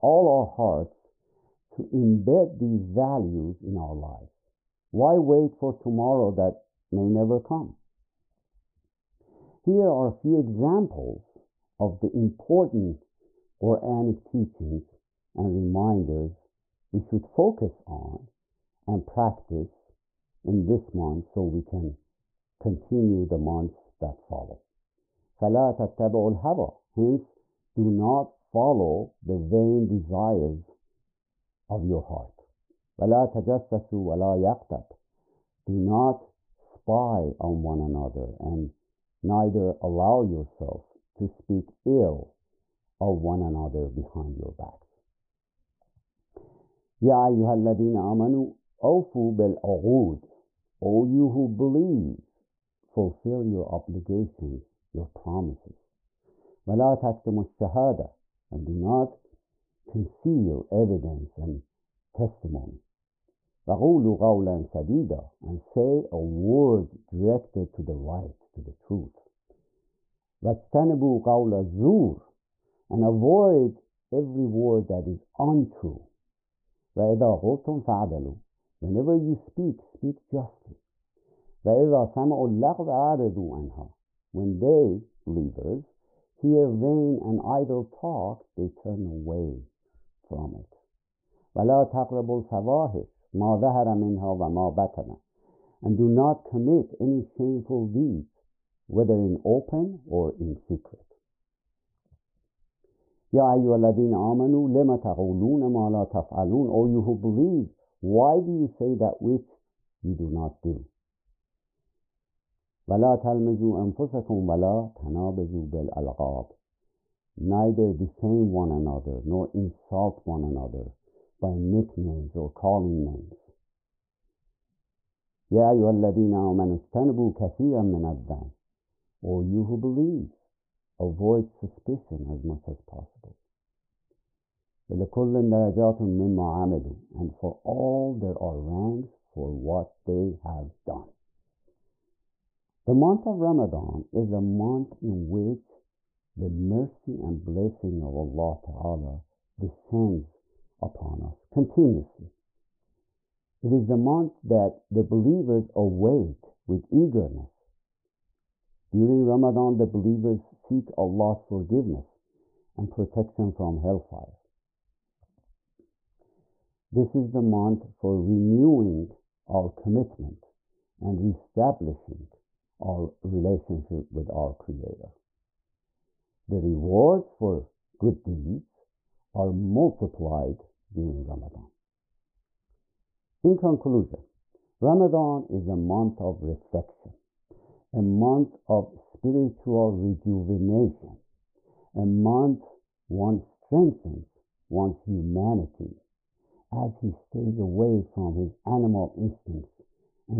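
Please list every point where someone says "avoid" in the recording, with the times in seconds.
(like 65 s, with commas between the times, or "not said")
73 s, 130 s.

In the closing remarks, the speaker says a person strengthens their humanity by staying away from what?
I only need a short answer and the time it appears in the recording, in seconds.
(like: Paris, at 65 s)
animal instincts, at 198 s.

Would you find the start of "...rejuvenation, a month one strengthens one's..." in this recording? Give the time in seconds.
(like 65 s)
189 s.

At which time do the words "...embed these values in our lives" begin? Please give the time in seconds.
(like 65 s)
1 s.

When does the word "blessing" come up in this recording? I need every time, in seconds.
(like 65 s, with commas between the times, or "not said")
147 s.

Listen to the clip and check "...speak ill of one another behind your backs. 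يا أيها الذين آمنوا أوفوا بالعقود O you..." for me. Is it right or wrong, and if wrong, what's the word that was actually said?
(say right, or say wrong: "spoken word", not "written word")
right.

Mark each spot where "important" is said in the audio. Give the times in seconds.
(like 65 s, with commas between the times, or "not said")
12 s.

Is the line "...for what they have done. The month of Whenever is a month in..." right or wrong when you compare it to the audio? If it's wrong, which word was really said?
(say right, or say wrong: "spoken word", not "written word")
wrong: "Ramadan", not "Whenever".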